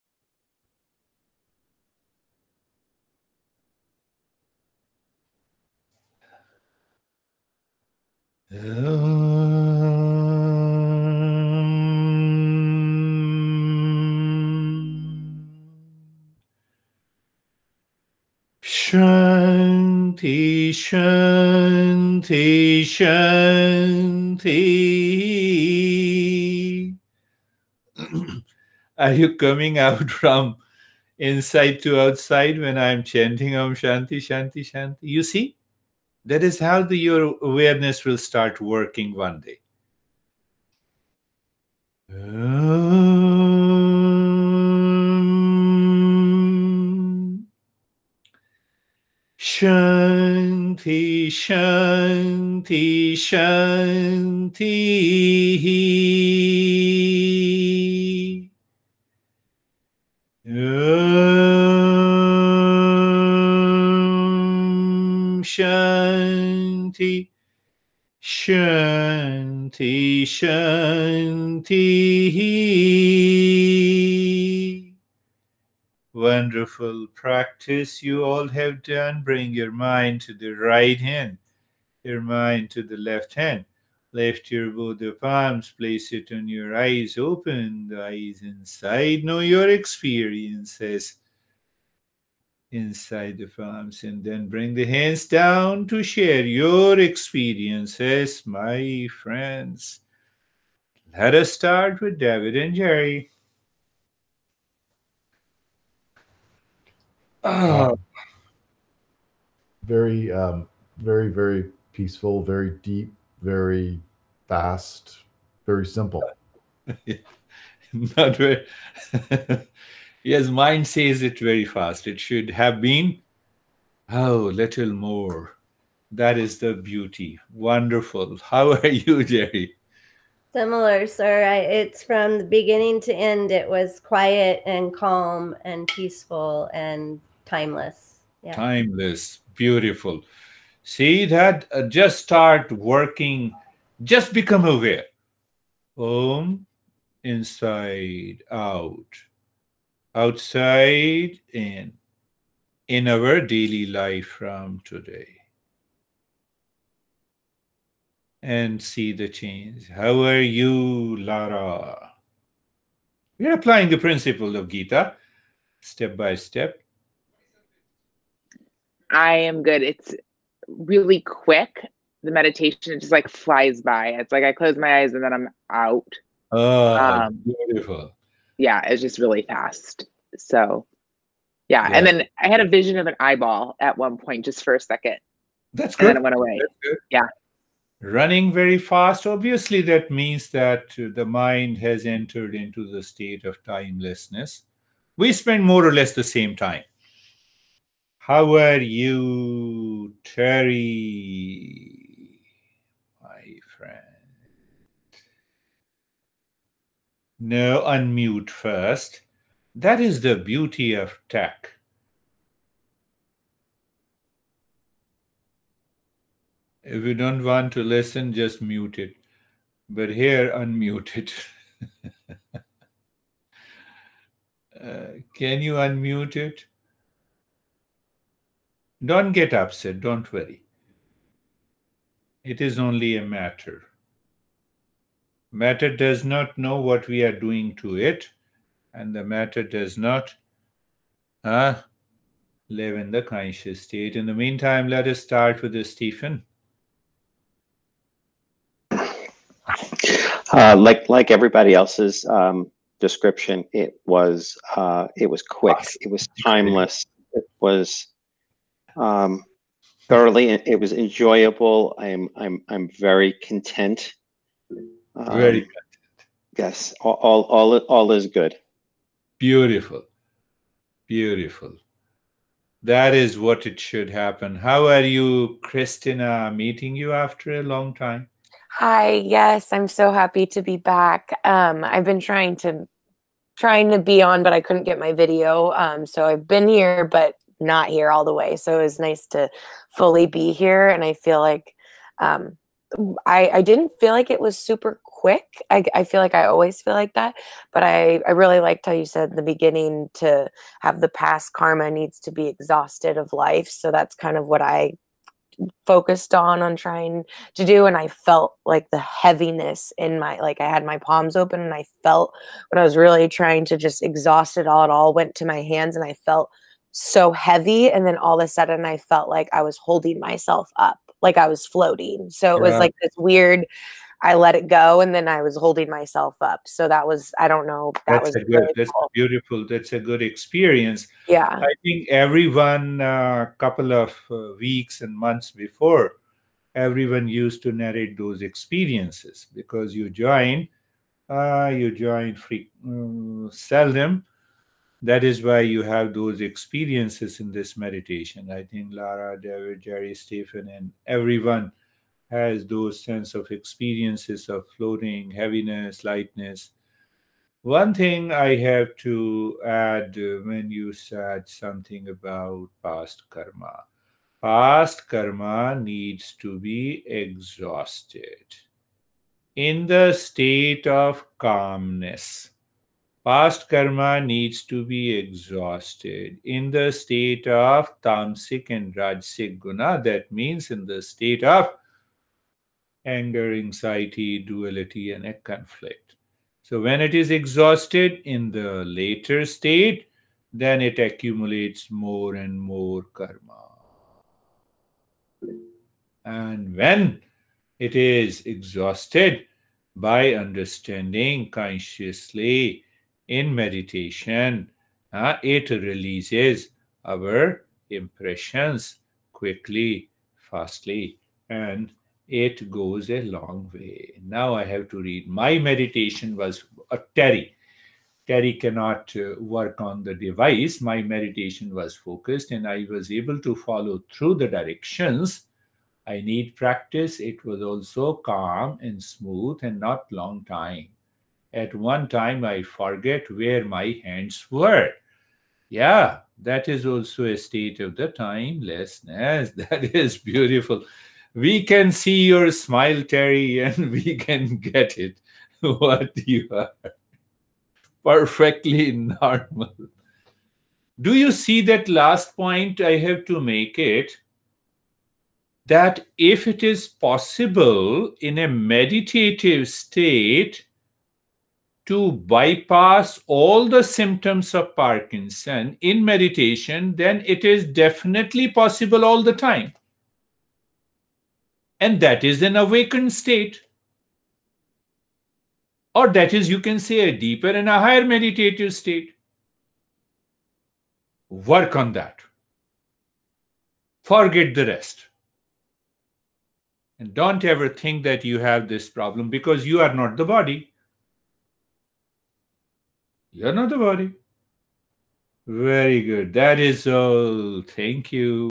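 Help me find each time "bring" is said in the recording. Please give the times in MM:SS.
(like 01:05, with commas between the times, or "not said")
01:19, 01:34.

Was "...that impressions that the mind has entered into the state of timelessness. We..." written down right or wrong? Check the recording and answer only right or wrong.
wrong.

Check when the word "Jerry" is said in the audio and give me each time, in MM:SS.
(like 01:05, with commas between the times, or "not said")
01:42, 02:09, 05:49.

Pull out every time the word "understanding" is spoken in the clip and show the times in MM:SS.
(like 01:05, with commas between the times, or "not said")
06:40.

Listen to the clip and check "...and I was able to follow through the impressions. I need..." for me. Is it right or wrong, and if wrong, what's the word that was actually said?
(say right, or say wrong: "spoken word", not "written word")
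wrong: "directions", not "impressions".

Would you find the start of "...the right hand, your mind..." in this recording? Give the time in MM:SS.
01:20.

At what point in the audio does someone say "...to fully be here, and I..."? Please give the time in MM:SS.
04:49.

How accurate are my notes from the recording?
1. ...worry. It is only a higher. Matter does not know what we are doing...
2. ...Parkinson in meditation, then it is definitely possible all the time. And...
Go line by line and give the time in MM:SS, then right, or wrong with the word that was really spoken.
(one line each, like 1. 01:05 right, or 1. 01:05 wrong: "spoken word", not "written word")
1. 03:50 wrong: "matter", not "higher"
2. 07:44 right.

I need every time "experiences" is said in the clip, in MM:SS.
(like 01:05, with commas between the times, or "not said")
01:29, 01:36, 05:30, 05:38, 05:46, 05:53.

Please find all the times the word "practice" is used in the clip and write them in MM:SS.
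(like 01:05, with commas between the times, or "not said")
01:17, 07:06.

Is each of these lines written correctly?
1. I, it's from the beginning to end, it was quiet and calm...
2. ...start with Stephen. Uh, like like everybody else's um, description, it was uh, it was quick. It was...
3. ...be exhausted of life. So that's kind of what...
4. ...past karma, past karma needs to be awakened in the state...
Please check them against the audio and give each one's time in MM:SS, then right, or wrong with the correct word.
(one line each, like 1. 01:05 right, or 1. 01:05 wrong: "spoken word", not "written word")
1. 02:11 right
2. 04:05 right
3. 05:02 right
4. 06:02 wrong: "exhausted", not "awakened".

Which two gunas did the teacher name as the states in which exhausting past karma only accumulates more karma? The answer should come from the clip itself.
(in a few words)
tamasic and rajasic.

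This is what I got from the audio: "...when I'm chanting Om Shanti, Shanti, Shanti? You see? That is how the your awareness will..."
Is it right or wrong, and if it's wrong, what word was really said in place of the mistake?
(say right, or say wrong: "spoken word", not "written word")
right.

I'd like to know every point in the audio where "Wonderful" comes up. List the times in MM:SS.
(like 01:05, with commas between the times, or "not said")
01:16, 02:07.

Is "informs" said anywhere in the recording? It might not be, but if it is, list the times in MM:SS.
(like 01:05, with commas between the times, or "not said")
not said.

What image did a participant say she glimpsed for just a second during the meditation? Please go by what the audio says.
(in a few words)
an eyeball.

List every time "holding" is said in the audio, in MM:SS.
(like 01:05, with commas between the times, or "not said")
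05:19, 05:25.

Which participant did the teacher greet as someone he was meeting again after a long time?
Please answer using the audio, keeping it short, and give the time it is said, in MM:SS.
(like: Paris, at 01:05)
Christina, at 04:35.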